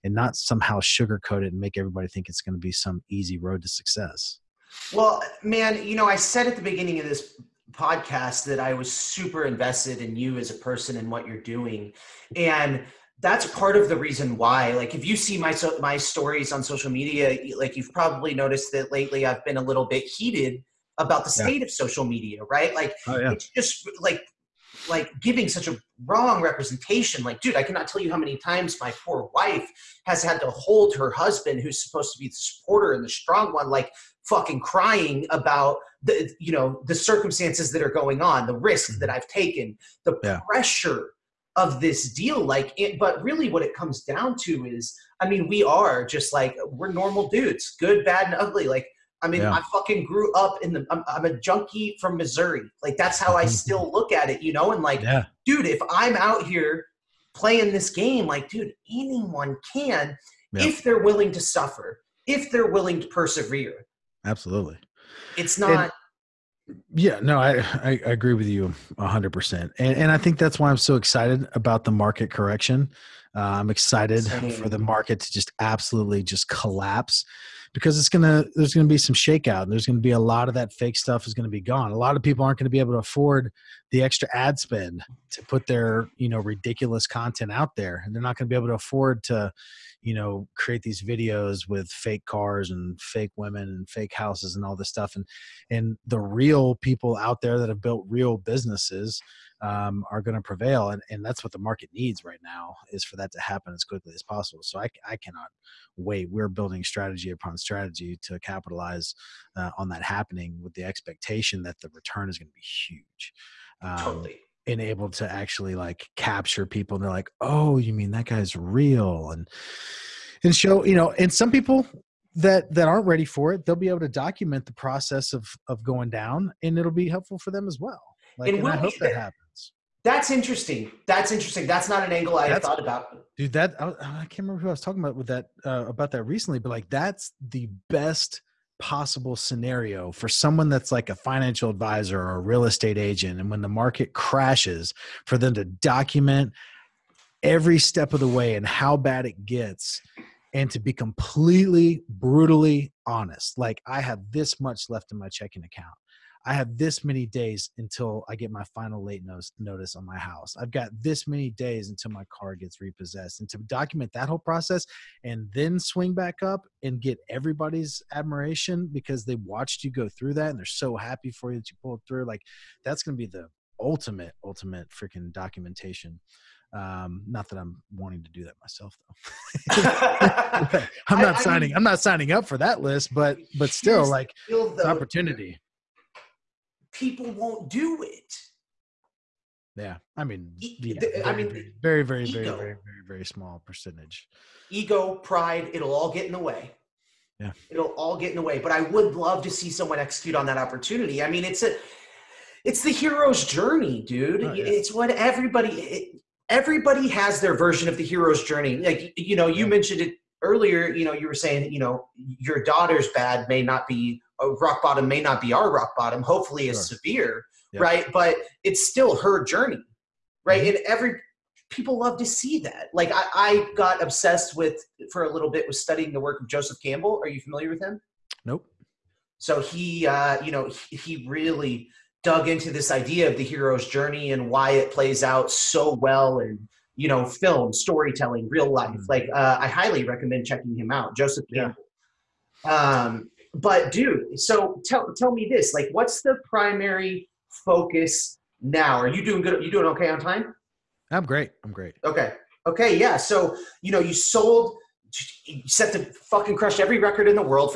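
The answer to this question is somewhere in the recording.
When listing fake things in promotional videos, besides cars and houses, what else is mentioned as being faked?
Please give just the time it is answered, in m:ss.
1:33.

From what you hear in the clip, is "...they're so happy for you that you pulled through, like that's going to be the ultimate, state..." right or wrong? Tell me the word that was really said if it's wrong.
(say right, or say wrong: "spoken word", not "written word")
wrong: "ultimate", not "state".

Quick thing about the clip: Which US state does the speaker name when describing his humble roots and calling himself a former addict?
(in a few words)
Missouri.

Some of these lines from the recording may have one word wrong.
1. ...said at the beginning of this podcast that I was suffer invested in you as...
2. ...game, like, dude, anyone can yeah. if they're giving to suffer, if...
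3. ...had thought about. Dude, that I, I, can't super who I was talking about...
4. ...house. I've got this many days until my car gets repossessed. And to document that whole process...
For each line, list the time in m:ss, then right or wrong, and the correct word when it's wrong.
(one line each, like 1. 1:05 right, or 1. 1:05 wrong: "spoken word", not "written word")
1. 0:06 wrong: "super", not "suffer"
2. 0:57 wrong: "willing", not "giving"
3. 2:12 wrong: "remember", not "super"
4. 2:40 right.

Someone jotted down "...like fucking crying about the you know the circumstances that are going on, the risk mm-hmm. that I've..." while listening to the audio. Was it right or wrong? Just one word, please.
right.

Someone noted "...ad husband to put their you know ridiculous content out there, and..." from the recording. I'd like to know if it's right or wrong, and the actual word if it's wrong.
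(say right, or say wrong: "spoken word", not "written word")
wrong: "spend", not "husband".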